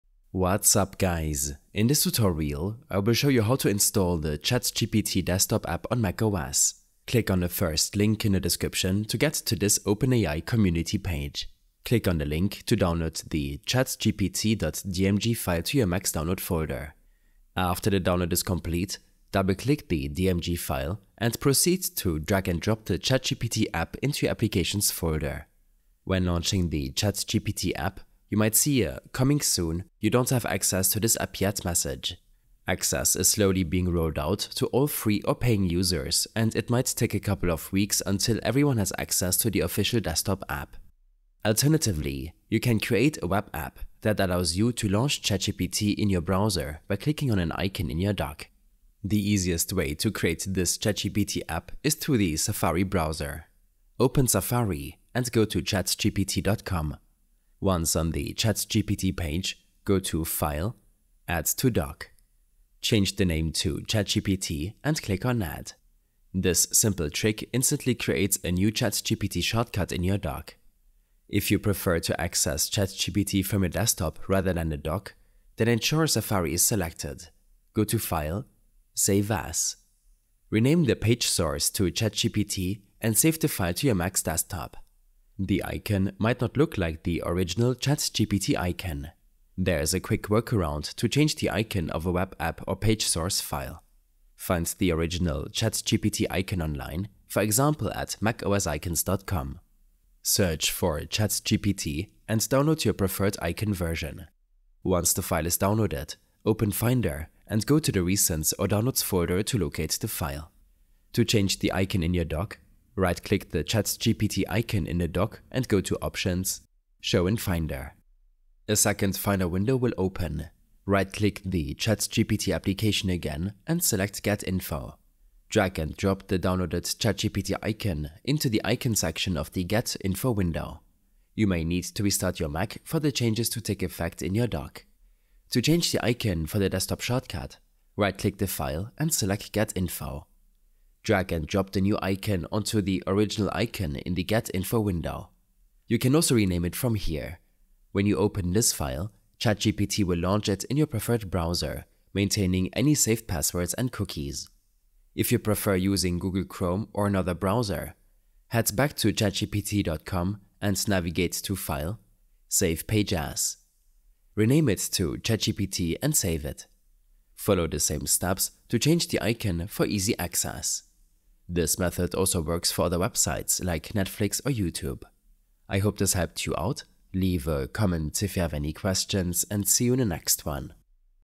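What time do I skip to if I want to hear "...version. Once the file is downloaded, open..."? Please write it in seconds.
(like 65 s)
103 s.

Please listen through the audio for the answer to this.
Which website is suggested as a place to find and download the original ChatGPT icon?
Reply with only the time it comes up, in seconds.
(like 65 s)
98 s.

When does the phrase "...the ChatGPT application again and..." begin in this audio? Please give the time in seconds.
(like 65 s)
121 s.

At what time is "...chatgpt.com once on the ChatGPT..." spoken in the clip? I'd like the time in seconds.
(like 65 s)
55 s.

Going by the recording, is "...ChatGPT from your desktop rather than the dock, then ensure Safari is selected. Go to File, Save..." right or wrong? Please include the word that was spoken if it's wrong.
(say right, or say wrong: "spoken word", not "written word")
right.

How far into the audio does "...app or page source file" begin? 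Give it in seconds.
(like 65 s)
92 s.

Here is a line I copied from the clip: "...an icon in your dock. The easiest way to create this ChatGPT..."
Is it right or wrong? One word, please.
right.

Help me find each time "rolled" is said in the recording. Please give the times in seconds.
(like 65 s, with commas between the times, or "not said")
33 s.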